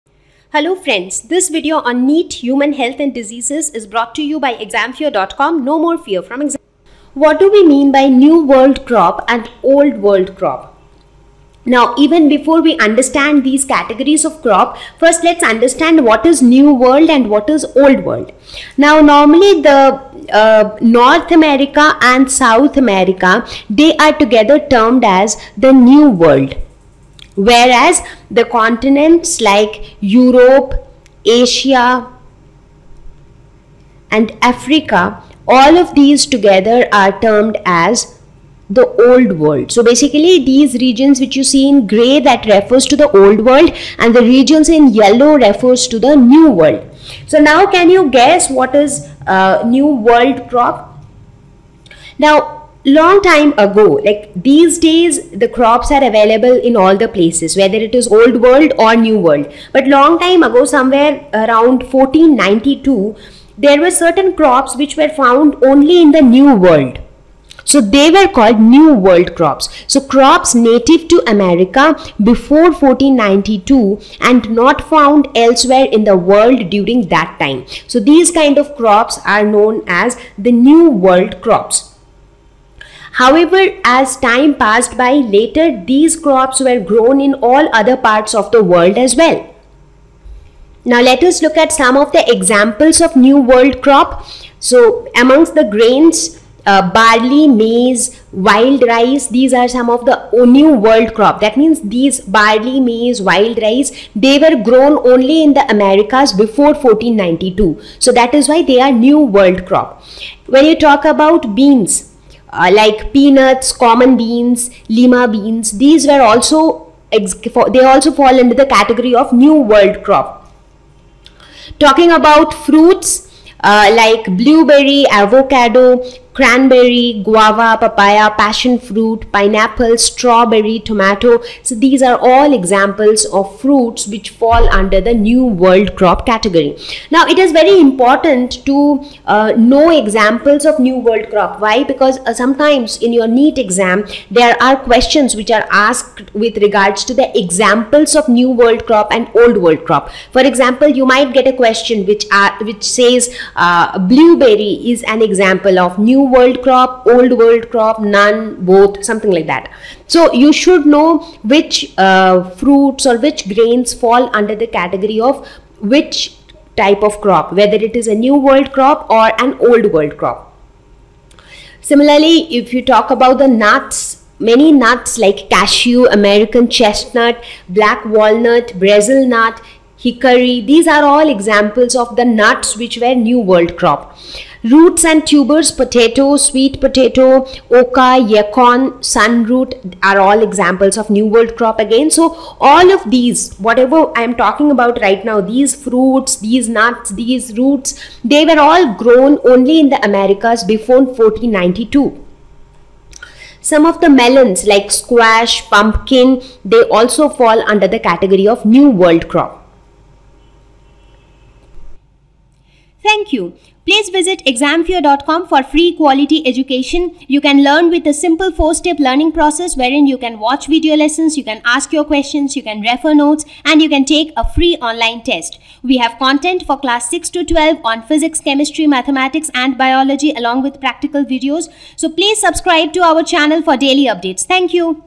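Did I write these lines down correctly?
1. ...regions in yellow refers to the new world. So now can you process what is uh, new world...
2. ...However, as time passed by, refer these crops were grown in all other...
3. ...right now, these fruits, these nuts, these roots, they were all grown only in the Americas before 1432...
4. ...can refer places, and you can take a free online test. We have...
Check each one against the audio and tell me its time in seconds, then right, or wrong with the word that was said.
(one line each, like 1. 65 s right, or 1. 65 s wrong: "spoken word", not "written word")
1. 44 s wrong: "guess", not "process"
2. 83 s wrong: "later", not "refer"
3. 195 s wrong: "1492", not "1432"
4. 222 s wrong: "notes", not "places".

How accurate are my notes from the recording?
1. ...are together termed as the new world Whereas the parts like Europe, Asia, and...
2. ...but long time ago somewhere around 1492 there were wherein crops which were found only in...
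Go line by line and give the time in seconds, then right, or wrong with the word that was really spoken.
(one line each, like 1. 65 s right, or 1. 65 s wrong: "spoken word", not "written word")
1. 23 s wrong: "continents", not "parts"
2. 59 s wrong: "certain", not "wherein".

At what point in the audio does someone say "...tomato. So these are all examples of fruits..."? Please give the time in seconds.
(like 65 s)
130 s.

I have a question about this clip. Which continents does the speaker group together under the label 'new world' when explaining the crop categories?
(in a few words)
North America and South America.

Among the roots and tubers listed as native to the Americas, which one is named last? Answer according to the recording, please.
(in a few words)
Sunroot.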